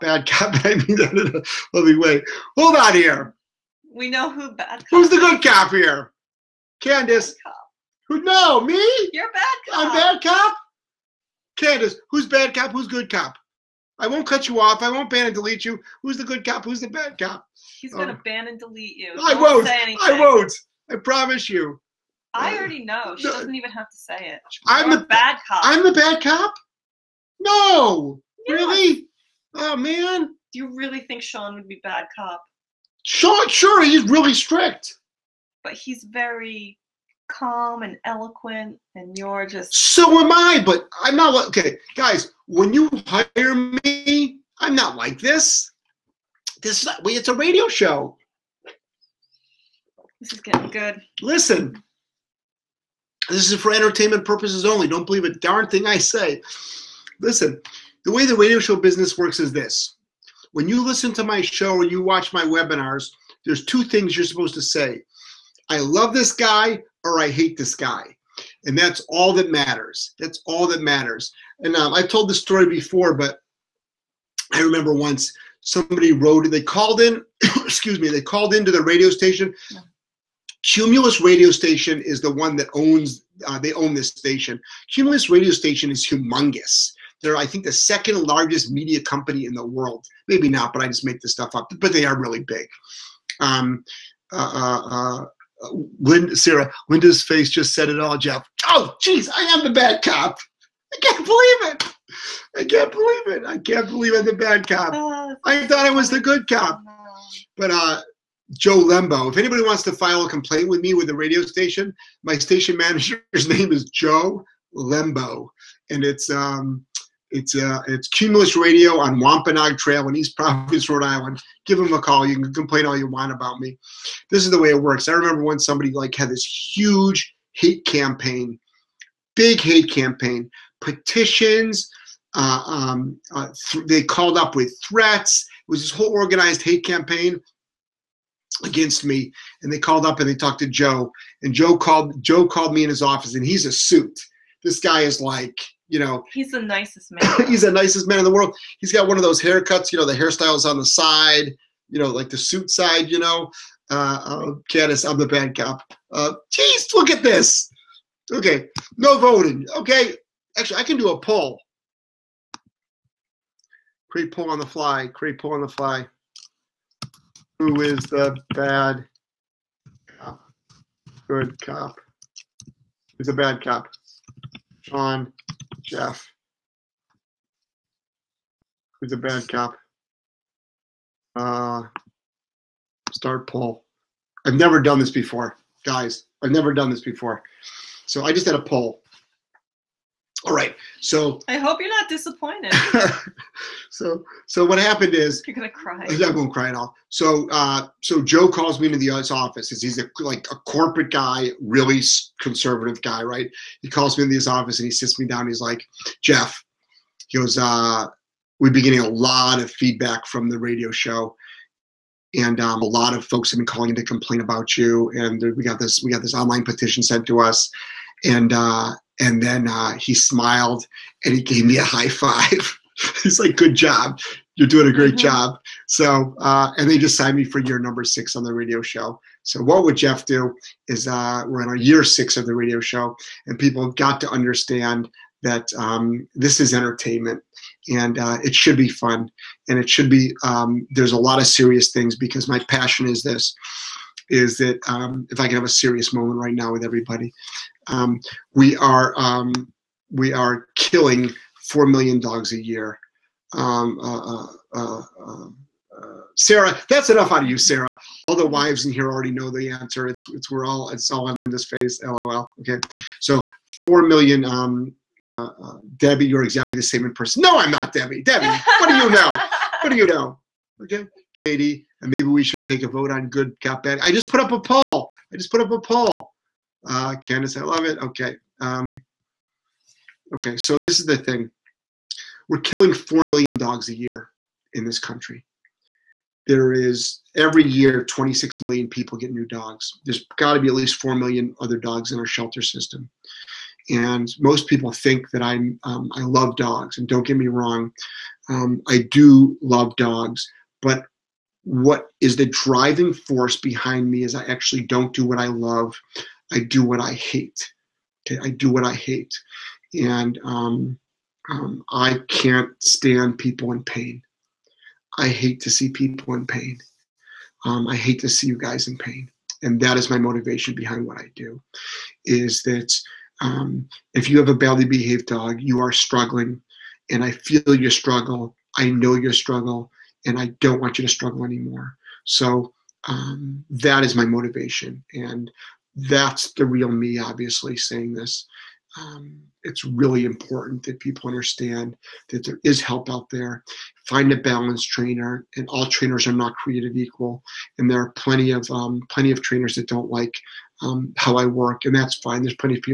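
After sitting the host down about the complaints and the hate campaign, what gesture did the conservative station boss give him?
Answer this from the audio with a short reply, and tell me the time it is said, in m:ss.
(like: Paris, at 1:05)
a high five, at 3:41.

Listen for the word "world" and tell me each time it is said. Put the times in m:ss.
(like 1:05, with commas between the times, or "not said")
1:29, 2:28.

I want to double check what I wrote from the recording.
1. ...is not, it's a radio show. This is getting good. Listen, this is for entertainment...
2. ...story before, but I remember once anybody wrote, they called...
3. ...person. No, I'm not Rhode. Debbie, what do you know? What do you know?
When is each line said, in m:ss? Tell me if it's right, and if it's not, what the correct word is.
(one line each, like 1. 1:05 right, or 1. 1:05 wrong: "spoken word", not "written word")
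1. 0:46 right
2. 1:12 wrong: "somebody", not "anybody"
3. 4:27 wrong: "Debbie", not "Rhode".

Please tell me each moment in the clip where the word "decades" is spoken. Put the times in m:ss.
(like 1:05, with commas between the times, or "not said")
not said.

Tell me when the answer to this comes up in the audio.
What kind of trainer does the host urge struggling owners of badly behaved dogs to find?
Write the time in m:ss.
5:44.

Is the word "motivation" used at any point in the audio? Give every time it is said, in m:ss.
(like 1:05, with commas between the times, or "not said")
5:20, 5:34.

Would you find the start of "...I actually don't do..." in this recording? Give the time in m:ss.
5:04.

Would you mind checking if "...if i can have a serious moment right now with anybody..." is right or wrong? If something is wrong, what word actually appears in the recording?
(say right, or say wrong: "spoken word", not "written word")
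wrong: "everybody", not "anybody".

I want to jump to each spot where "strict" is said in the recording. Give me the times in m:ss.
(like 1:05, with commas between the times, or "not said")
0:34.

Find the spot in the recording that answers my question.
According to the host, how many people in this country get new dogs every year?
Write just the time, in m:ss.
4:48.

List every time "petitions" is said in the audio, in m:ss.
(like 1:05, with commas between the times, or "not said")
2:10, 3:36.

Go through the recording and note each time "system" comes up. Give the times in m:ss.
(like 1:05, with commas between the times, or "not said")
4:52.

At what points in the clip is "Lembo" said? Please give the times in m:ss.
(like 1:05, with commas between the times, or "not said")
1:48, 1:54.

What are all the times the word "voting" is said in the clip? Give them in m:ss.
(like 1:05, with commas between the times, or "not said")
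2:39.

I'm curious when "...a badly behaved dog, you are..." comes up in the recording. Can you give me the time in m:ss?
5:24.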